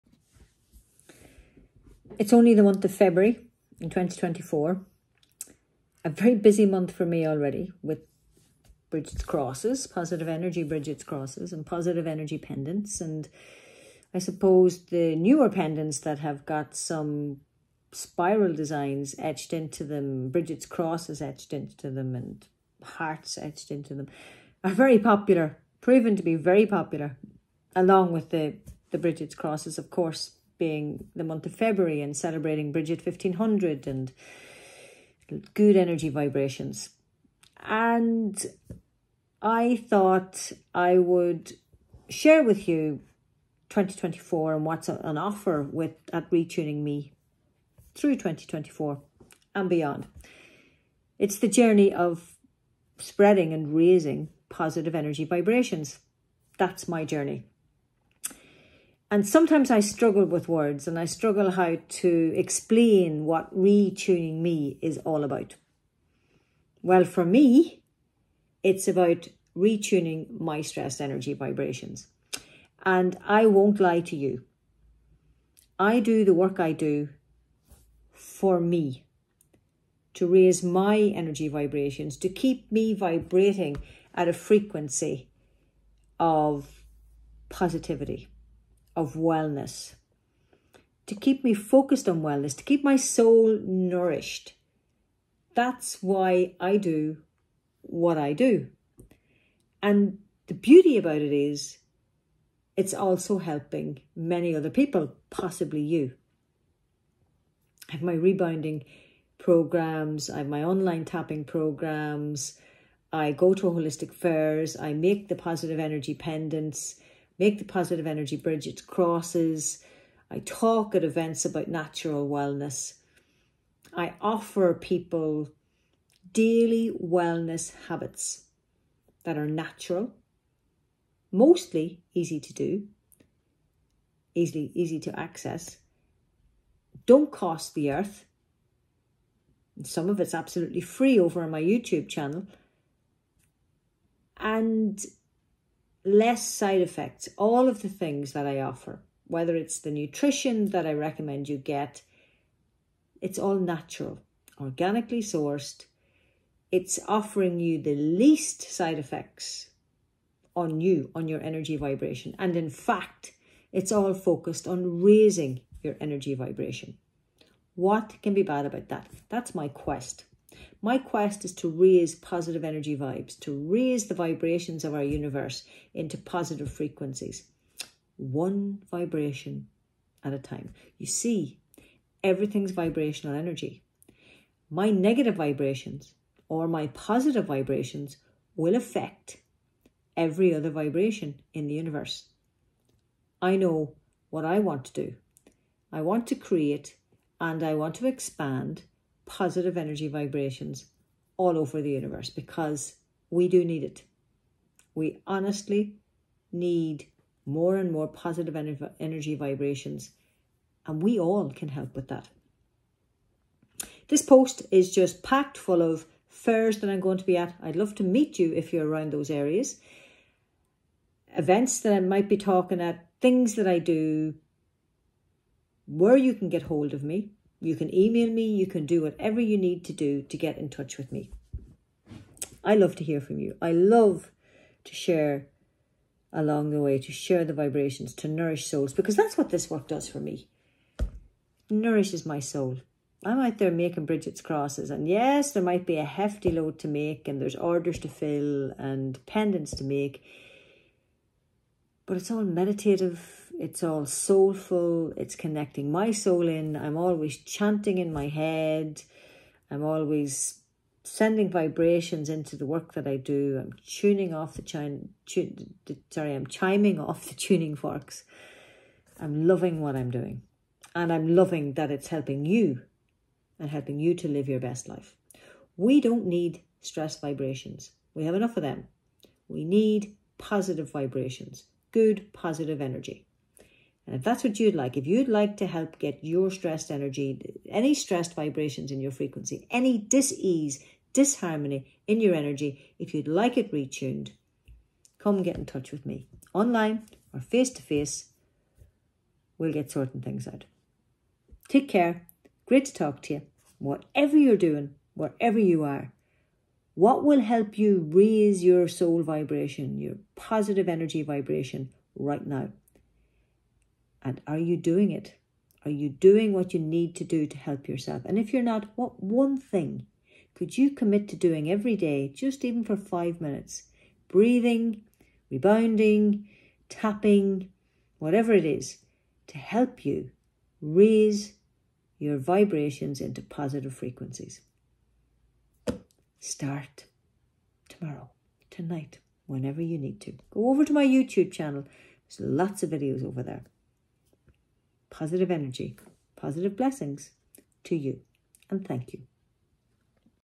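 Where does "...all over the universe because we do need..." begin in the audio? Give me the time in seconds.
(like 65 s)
201 s.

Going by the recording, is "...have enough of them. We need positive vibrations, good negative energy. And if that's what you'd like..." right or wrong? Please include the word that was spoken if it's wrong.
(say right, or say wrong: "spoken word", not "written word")
wrong: "positive", not "negative".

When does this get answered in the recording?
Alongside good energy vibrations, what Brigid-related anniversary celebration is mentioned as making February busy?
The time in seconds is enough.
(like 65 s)
32 s.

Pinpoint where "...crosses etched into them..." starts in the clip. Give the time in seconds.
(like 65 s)
20 s.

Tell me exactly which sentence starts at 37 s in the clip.
And I thought I would share with you 2024 and what's on offer with at RetuningME through 2024 and beyond.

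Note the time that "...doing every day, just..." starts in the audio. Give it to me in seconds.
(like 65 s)
321 s.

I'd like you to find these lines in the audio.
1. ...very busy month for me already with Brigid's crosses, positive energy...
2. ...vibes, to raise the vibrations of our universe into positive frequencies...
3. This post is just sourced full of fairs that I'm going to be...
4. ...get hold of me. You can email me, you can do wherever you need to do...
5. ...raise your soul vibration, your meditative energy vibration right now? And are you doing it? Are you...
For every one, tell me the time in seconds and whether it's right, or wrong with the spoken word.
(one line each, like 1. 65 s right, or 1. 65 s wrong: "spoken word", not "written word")
1. 6 s right
2. 172 s right
3. 214 s wrong: "packed", not "sourced"
4. 226 s wrong: "whatever", not "wherever"
5. 308 s wrong: "positive", not "meditative".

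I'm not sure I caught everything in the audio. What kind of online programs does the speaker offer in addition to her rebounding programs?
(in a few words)
tapping programs.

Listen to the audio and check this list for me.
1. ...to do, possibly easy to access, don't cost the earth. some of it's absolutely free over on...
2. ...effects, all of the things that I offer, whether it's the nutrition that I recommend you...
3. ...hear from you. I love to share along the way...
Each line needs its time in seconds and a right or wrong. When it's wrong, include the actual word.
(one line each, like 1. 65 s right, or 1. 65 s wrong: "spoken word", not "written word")
1. 132 s wrong: "easily", not "possibly"
2. 146 s right
3. 233 s right.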